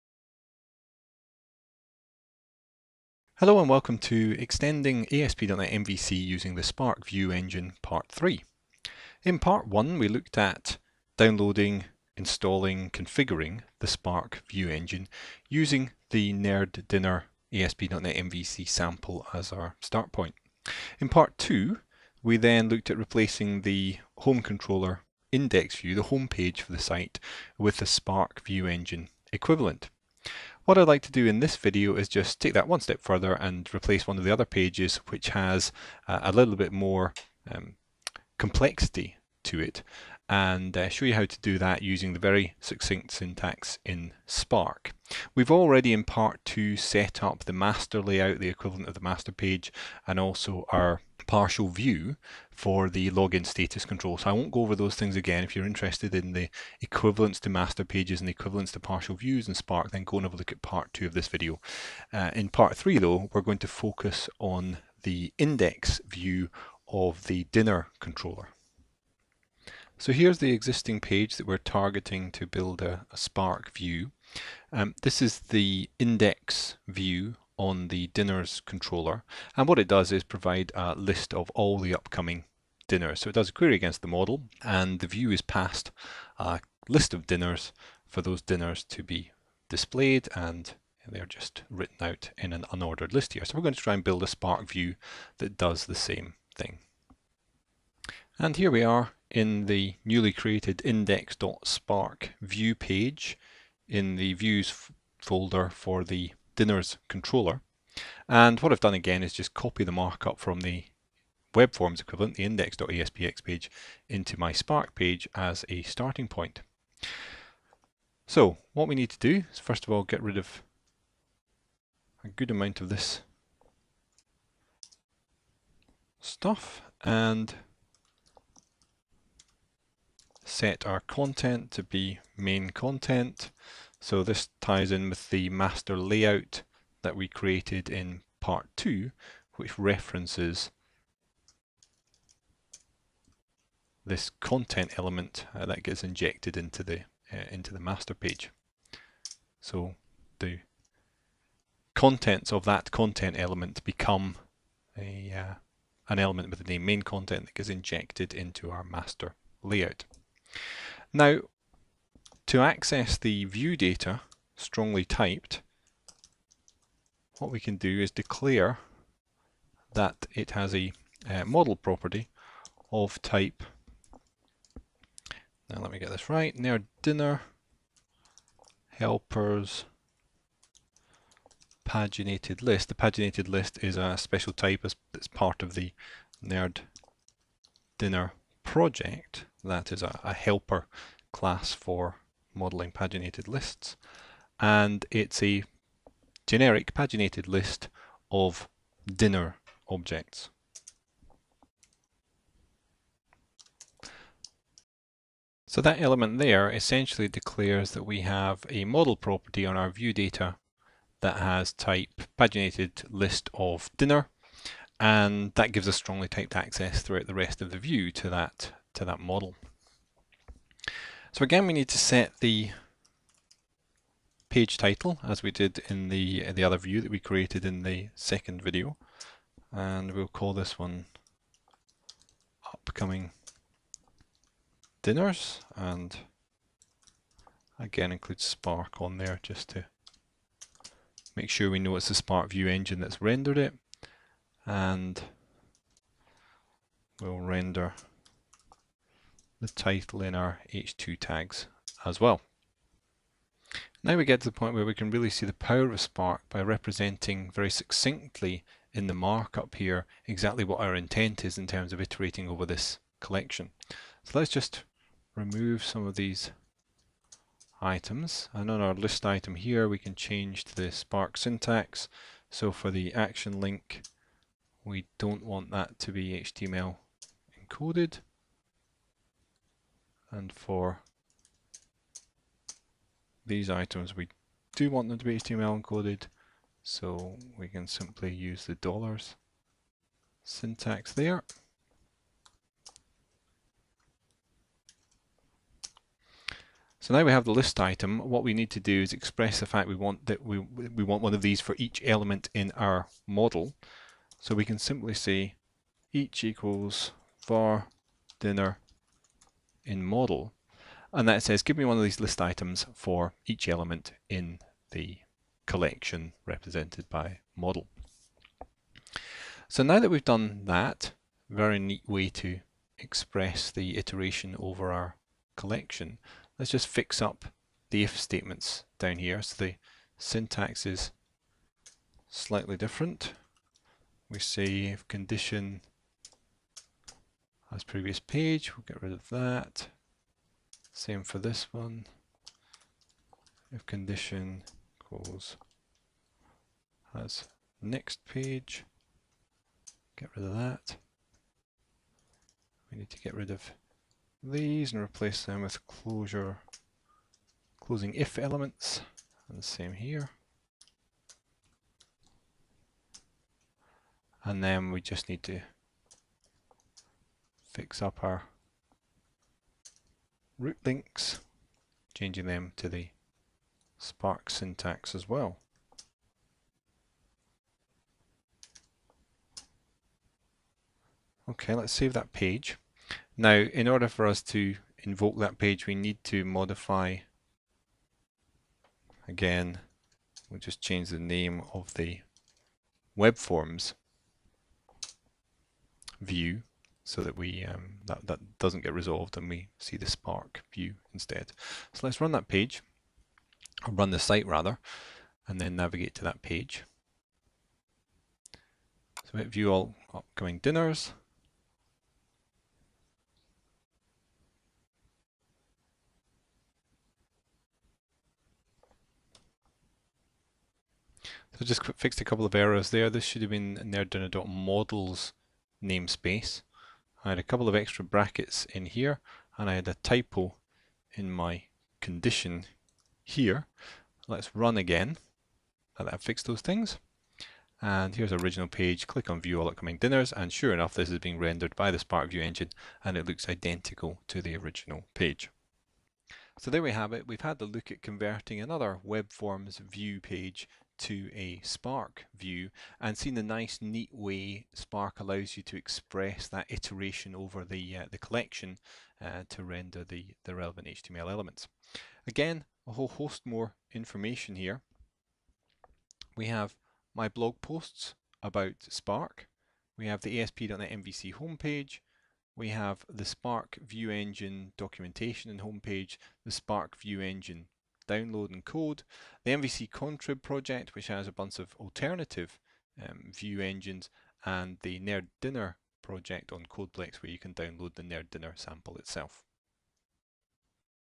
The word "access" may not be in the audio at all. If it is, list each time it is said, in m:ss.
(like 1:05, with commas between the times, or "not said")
2:42, 3:36.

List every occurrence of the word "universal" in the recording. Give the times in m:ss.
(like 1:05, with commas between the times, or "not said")
not said.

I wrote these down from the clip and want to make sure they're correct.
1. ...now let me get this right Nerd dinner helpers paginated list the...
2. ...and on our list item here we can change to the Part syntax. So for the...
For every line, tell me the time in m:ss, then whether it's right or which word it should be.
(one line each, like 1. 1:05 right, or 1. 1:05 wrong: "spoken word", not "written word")
1. 2:55 right
2. 4:28 wrong: "Spark", not "Part".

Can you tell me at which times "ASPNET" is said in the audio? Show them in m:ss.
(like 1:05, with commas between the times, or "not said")
0:05, 0:17, 7:50.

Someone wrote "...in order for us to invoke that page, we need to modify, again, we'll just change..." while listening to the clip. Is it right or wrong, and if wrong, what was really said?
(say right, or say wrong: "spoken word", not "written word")
right.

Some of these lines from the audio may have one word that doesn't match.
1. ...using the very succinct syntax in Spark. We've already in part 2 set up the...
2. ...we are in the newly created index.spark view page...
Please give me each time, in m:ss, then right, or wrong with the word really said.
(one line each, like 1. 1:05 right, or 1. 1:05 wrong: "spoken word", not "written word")
1. 0:41 right
2. 1:38 right.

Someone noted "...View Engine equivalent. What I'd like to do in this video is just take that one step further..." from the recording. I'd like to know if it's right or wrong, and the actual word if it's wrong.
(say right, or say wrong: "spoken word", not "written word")
right.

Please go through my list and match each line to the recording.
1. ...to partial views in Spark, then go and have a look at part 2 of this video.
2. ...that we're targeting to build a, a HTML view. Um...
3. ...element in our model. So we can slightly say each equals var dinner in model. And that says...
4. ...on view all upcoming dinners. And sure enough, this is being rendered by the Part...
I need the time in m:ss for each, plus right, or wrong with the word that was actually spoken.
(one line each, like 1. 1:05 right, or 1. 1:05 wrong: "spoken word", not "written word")
1. 0:58 right
2. 1:11 wrong: "Spark", not "HTML"
3. 5:02 wrong: "simply", not "slightly"
4. 7:19 wrong: "Spark", not "Part".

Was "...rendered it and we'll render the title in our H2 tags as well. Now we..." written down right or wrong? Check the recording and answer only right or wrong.
right.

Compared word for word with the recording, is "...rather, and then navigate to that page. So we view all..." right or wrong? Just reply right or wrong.
right.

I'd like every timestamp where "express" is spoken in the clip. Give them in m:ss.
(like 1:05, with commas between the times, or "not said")
4:59, 5:22, 7:35.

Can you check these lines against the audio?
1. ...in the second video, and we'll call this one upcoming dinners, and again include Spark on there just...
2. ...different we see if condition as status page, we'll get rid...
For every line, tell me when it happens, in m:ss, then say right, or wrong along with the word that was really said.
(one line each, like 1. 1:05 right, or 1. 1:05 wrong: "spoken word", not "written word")
1. 3:47 right
2. 5:32 wrong: "previous", not "status".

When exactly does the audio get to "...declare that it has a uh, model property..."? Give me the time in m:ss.
2:48.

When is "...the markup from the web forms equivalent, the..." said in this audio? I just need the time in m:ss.
1:49.